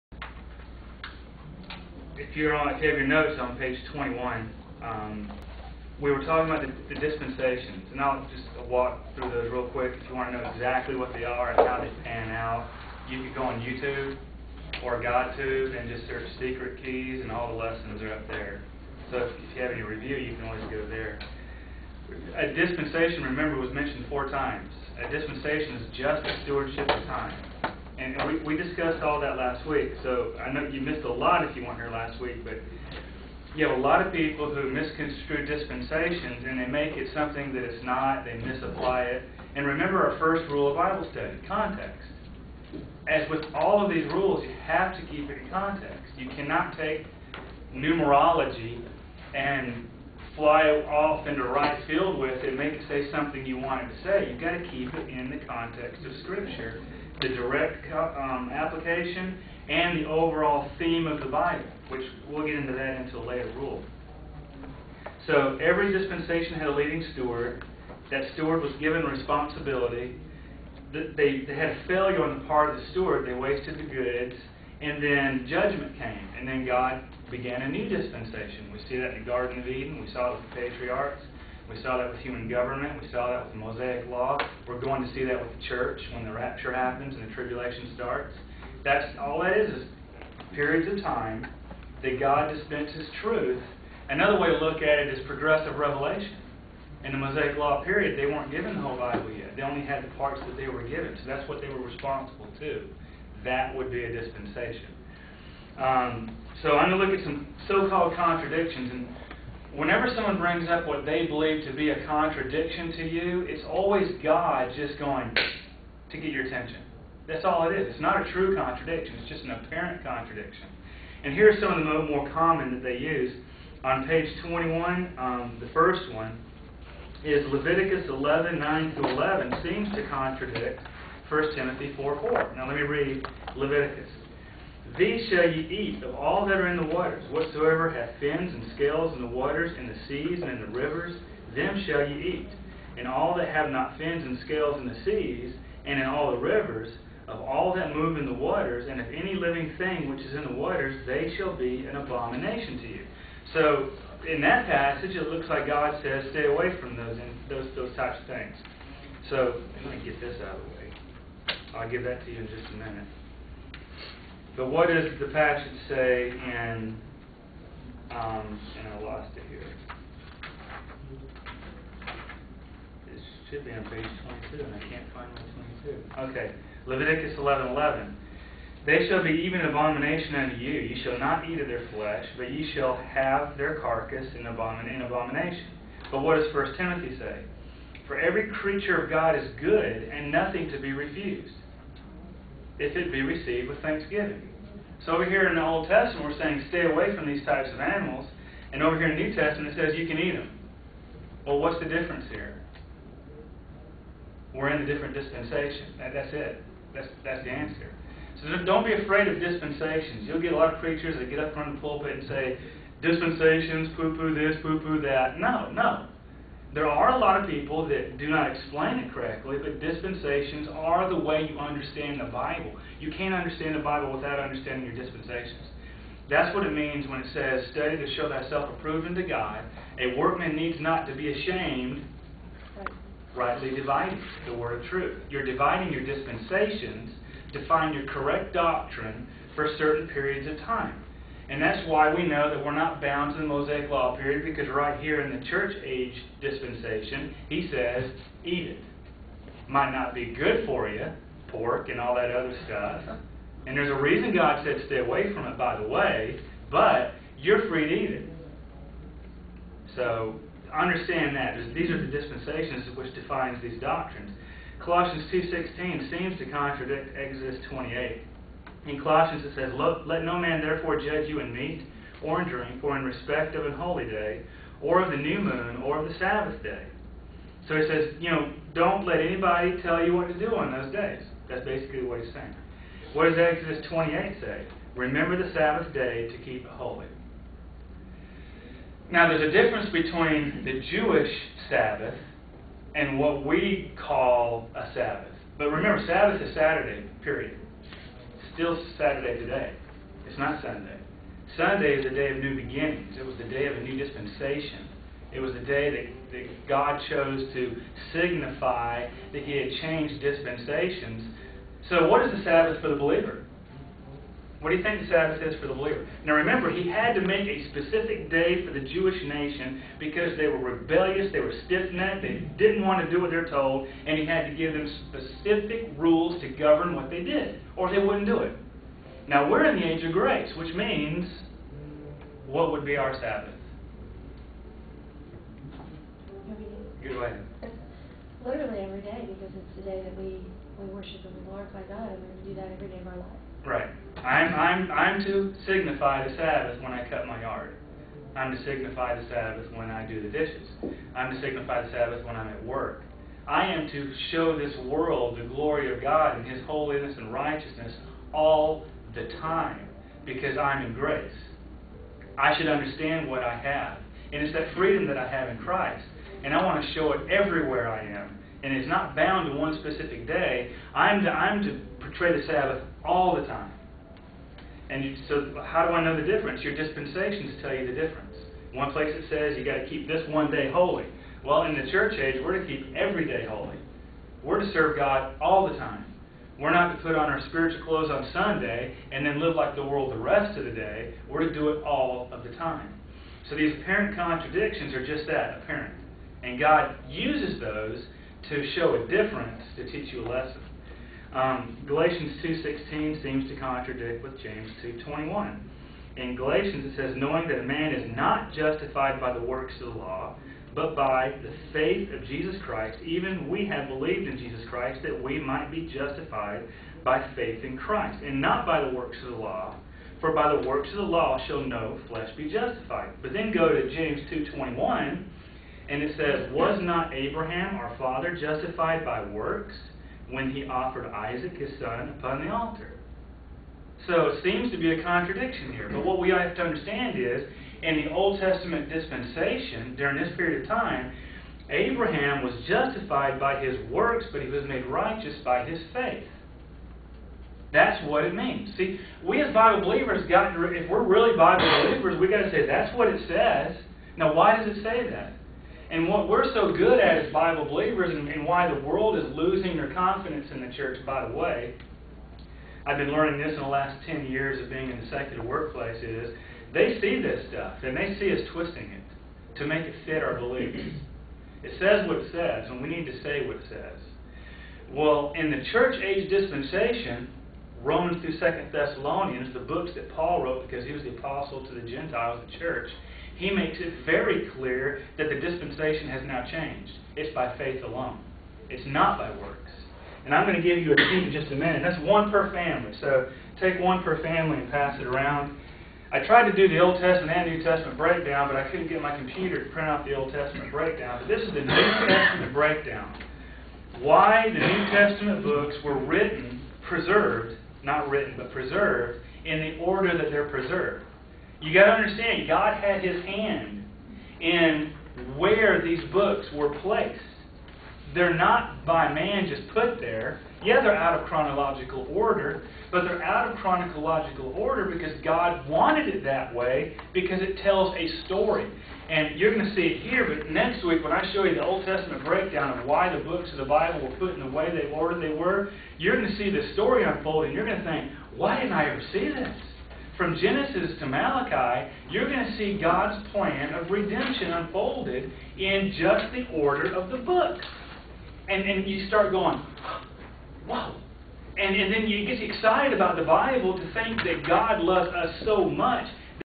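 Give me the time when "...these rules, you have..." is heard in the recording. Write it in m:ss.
0:43.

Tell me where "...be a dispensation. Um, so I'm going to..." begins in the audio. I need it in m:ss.
1:43.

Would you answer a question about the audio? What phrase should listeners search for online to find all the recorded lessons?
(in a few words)
secret keys.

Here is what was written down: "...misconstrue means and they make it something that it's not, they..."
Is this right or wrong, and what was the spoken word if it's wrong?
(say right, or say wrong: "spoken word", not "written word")
wrong: "dispensations", not "means".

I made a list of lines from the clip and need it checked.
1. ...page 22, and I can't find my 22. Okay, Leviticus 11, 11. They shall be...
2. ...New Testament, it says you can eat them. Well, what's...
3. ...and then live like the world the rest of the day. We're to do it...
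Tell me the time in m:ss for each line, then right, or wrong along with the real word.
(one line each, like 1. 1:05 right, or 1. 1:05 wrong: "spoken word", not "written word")
1. 2:53 right
2. 3:19 right
3. 6:29 right.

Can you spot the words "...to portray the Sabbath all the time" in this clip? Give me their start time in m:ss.
6:11.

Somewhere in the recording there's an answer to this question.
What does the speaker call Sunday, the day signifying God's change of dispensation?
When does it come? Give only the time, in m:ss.
5:02.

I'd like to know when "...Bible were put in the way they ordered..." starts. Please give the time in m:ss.
8:53.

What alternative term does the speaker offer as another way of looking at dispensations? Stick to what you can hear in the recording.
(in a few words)
progressive revelation.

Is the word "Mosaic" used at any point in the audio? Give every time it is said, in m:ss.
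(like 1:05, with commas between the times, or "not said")
1:23, 1:37, 4:03.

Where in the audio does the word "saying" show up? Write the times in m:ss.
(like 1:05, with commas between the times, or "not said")
3:16, 4:42.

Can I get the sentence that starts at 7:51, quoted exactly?
It says what it says, and we need to say what it says.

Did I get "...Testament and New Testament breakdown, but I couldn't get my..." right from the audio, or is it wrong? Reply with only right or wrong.
right.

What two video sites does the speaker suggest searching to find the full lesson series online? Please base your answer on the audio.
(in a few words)
YouTube or GodTube.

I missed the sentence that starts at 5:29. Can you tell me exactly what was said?
Now we're in the age of grace, which means what would be our Sabbath?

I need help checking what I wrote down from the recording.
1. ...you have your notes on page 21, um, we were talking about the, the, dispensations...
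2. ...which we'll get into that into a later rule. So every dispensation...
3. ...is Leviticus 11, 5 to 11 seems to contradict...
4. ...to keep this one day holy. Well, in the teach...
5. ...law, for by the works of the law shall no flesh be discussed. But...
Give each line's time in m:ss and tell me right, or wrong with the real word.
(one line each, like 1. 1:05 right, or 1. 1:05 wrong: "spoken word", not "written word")
1. 0:02 right
2. 1:01 right
3. 2:07 wrong: "9", not "5"
4. 6:19 wrong: "church", not "teach"
5. 6:59 wrong: "justified", not "discussed".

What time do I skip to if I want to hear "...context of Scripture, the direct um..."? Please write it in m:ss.
0:55.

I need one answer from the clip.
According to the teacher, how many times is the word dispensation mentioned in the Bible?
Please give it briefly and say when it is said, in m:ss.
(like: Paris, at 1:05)
4, at 0:24.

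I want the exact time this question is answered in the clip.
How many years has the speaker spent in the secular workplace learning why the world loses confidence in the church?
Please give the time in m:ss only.
7:44.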